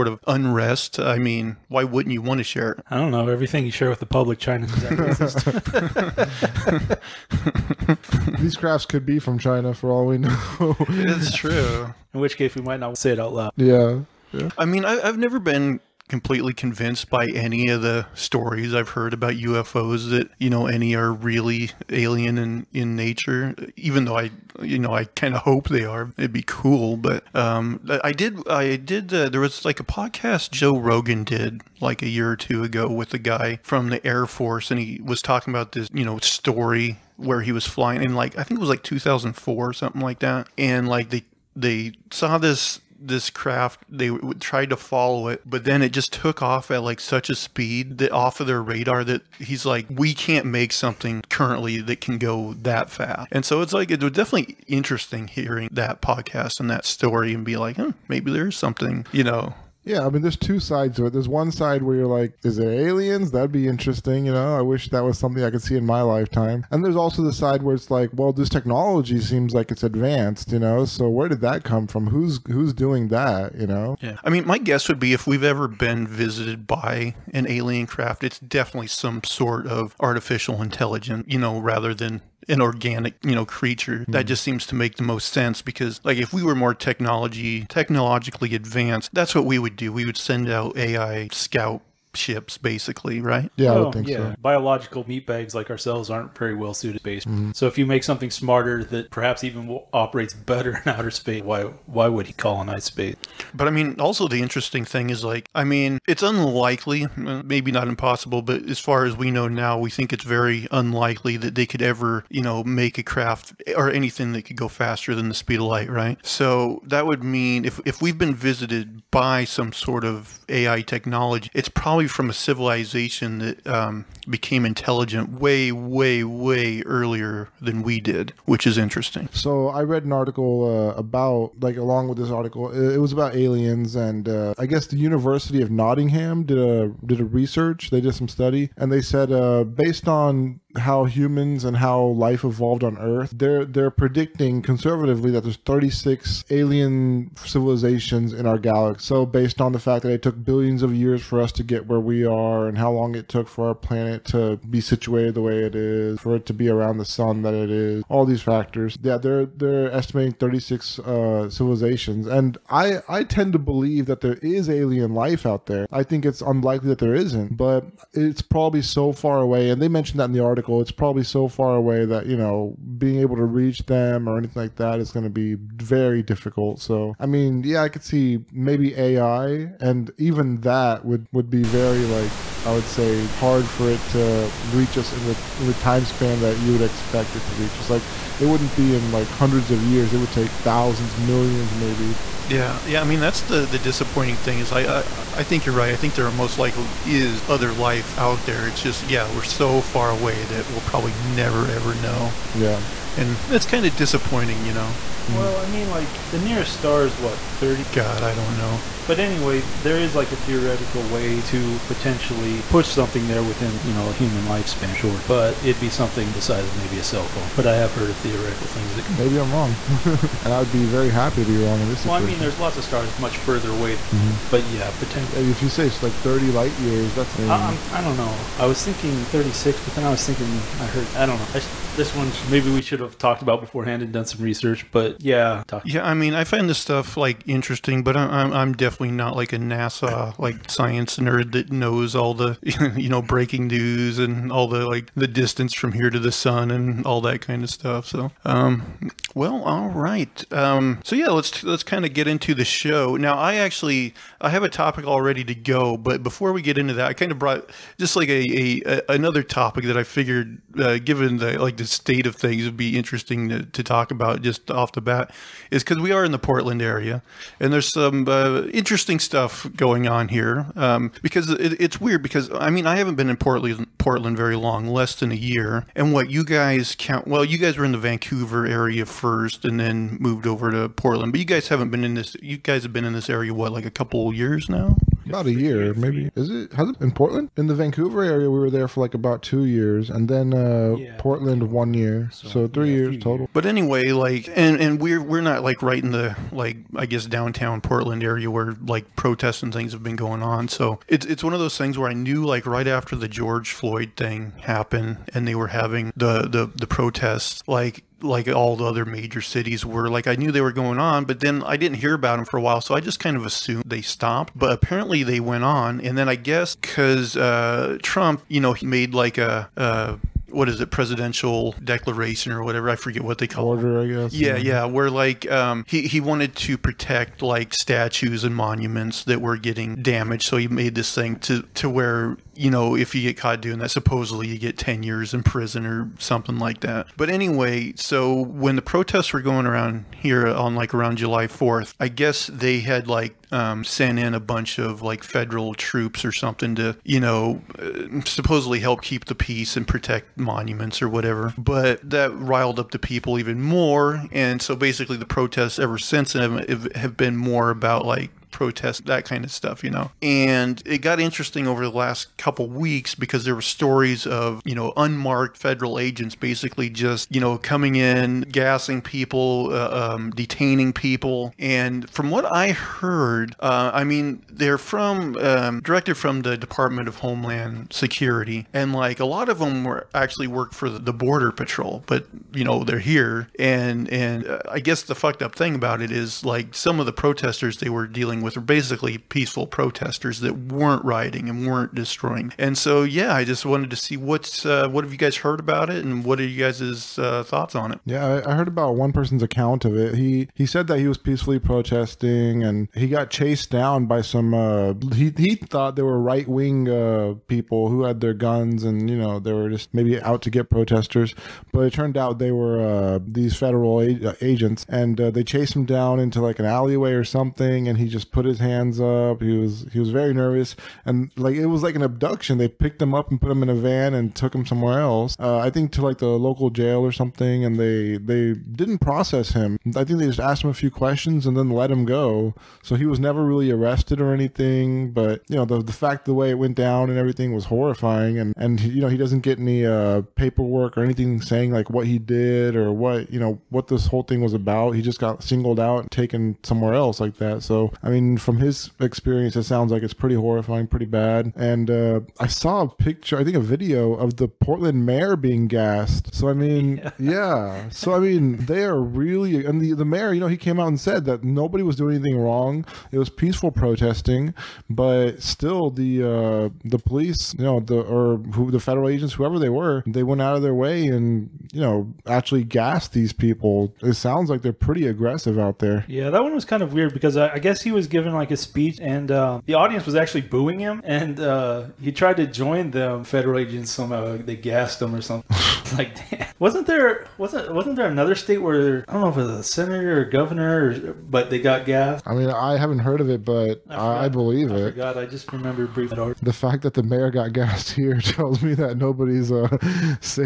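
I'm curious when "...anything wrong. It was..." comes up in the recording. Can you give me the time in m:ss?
7:42.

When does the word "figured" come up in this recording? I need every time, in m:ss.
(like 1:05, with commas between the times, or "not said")
4:20.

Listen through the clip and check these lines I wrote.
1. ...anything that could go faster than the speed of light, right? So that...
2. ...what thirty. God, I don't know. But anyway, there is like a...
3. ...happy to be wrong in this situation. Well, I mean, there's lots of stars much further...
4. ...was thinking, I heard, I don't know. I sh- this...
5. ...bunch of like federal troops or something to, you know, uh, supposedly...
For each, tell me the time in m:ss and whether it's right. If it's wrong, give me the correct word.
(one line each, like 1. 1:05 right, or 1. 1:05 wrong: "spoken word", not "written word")
1. 1:53 right
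2. 3:27 right
3. 3:41 right
4. 3:50 right
5. 5:44 right.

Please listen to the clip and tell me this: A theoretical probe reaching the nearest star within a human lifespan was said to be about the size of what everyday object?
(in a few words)
a cell phone.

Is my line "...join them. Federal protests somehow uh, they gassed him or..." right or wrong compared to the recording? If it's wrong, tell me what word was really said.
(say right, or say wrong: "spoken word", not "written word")
wrong: "agents", not "protests".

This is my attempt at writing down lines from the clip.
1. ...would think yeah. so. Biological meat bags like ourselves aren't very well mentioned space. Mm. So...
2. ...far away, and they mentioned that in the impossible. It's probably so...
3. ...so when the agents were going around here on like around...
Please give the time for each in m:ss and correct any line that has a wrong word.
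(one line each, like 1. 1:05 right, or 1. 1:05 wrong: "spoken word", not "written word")
1. 1:33 wrong: "suited", not "mentioned"
2. 2:49 wrong: "article", not "impossible"
3. 5:37 wrong: "protests", not "agents".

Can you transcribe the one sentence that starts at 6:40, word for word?
He he said that he was peacefully protesting, and he got chased down by some.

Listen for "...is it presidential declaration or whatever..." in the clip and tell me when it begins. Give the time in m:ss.
5:20.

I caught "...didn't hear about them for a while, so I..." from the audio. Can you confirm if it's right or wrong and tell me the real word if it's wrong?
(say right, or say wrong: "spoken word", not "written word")
right.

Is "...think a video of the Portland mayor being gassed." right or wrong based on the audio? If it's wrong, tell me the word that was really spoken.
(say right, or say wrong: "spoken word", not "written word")
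right.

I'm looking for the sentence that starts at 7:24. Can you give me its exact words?
He just got singled out and taken somewhere else like that.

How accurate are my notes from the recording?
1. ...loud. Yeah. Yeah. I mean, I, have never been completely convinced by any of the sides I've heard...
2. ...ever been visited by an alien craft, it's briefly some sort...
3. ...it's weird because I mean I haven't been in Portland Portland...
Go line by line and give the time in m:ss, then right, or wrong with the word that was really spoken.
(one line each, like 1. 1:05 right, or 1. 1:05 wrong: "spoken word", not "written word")
1. 0:13 wrong: "stories", not "sides"
2. 1:15 wrong: "definitely", not "briefly"
3. 4:31 right.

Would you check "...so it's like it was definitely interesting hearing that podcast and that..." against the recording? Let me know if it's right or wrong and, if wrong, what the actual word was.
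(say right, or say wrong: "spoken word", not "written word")
right.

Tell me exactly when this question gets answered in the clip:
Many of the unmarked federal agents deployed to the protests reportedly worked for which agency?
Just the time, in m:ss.
6:21.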